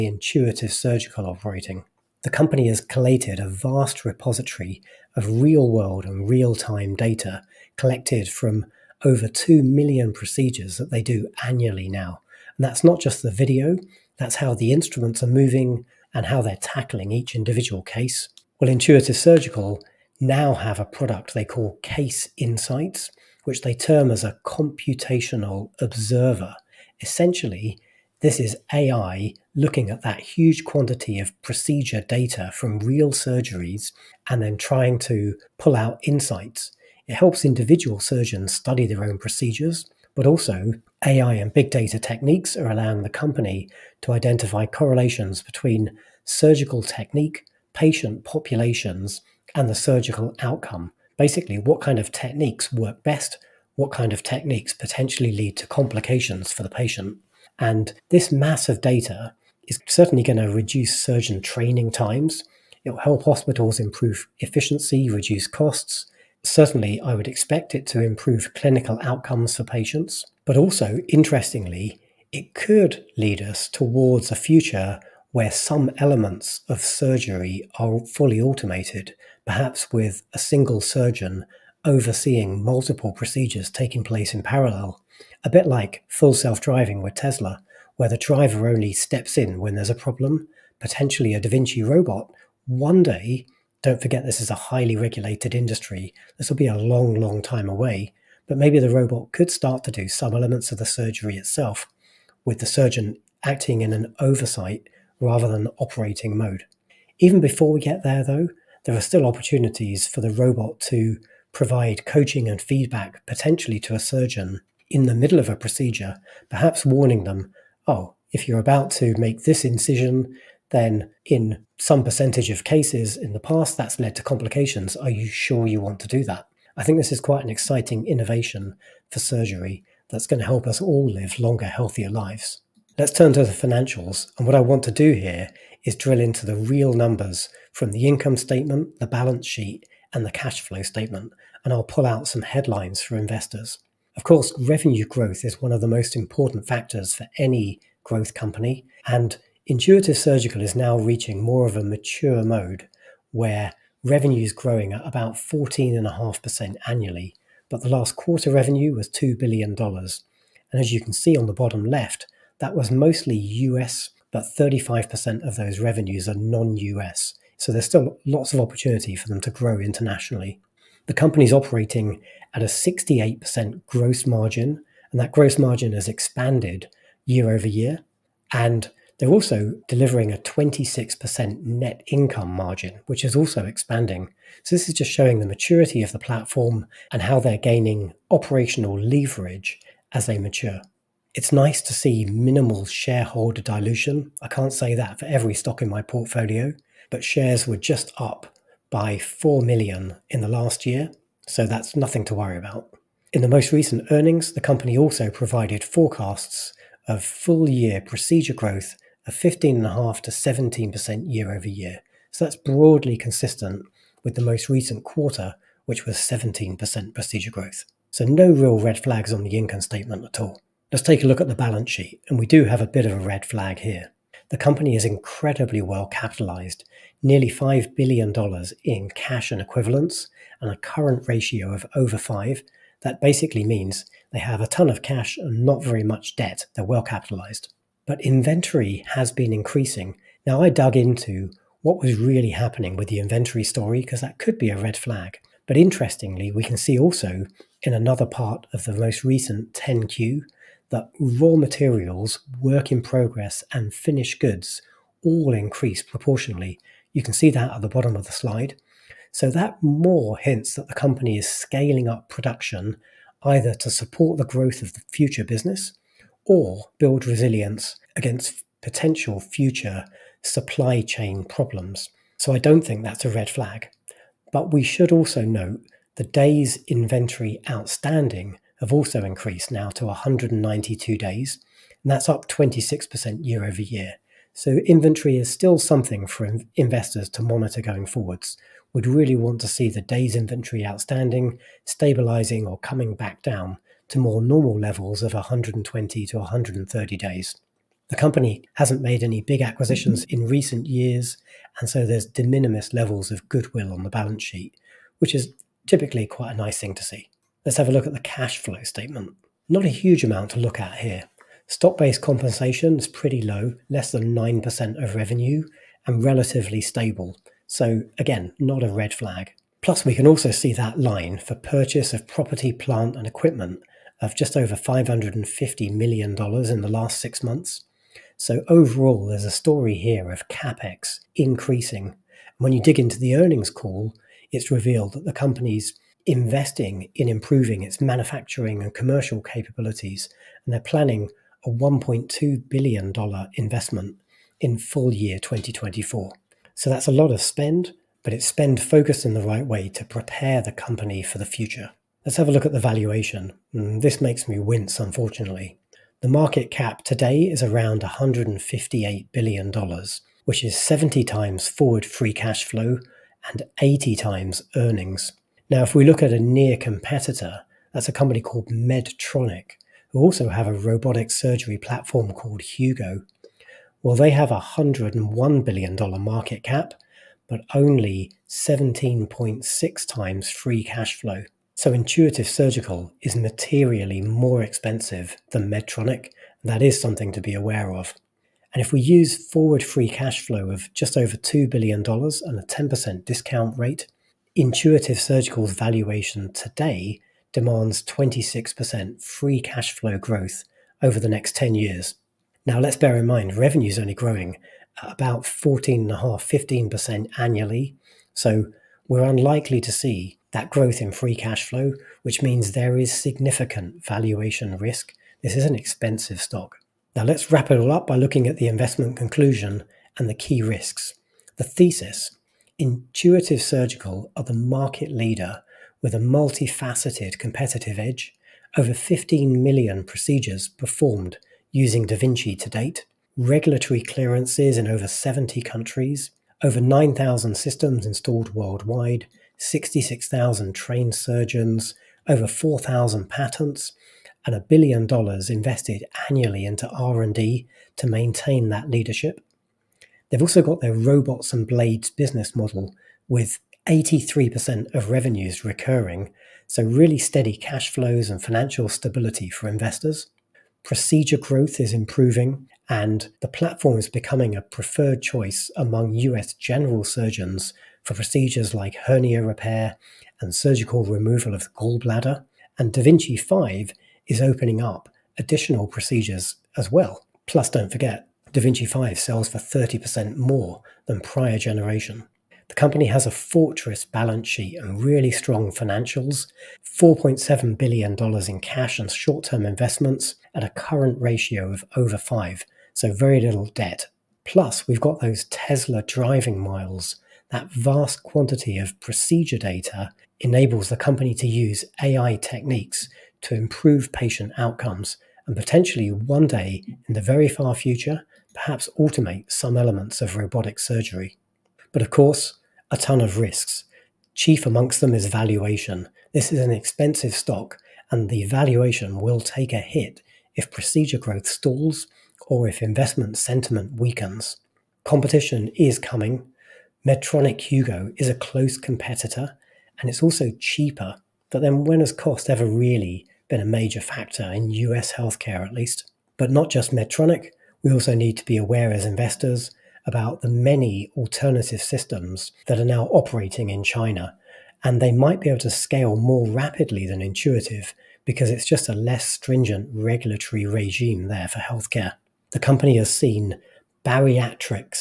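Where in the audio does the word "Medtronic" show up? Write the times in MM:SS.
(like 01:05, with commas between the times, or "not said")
06:08, 06:25, 08:47, 08:56.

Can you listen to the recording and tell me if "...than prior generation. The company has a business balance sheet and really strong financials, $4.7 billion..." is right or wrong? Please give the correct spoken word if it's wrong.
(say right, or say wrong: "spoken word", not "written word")
wrong: "fortress", not "business".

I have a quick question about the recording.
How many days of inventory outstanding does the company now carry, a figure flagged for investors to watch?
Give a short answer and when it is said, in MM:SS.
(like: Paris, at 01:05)
192 days, at 04:40.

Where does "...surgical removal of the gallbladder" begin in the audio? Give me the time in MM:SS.
07:50.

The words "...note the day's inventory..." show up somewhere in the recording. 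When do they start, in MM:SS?
04:35.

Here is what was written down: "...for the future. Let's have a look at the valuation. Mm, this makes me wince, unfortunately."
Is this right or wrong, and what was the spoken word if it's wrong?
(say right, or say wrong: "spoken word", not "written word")
right.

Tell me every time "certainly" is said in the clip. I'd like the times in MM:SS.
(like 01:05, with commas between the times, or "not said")
00:59, 01:06.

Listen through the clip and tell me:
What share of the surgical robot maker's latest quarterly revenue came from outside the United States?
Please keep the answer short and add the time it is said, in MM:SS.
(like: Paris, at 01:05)
35%, at 02:44.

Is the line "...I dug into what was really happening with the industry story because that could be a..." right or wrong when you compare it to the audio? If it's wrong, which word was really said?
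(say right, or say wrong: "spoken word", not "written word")
wrong: "inventory", not "industry".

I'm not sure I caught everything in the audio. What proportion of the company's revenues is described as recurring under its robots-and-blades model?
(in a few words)
83%.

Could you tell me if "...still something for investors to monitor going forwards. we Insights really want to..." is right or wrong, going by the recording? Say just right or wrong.
wrong.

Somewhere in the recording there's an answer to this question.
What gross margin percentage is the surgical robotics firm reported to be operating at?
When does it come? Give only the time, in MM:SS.
02:52.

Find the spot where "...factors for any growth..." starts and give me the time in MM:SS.
02:26.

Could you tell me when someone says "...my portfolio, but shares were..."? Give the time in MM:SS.
03:15.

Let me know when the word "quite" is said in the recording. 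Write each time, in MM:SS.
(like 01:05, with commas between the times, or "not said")
02:07, 05:06.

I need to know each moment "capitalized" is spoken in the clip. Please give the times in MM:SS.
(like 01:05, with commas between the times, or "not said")
03:46, 03:57.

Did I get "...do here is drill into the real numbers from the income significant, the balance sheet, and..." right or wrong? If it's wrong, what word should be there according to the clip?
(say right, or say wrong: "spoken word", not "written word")
wrong: "statement", not "significant".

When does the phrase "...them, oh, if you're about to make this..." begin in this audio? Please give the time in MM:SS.
01:57.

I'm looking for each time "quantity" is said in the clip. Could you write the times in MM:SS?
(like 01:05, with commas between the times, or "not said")
00:30, 08:18.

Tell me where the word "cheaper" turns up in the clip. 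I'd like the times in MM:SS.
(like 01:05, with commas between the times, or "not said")
08:50.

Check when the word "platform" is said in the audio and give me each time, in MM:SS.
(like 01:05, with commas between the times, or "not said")
03:06, 06:11, 07:43.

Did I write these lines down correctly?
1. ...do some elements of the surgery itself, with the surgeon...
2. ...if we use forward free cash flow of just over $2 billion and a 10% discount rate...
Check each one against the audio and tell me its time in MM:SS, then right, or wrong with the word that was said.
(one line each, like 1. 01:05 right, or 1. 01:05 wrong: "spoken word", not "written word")
1. 01:39 right
2. 06:28 right.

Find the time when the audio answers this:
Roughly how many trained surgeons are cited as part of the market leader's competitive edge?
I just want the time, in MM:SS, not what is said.
07:19.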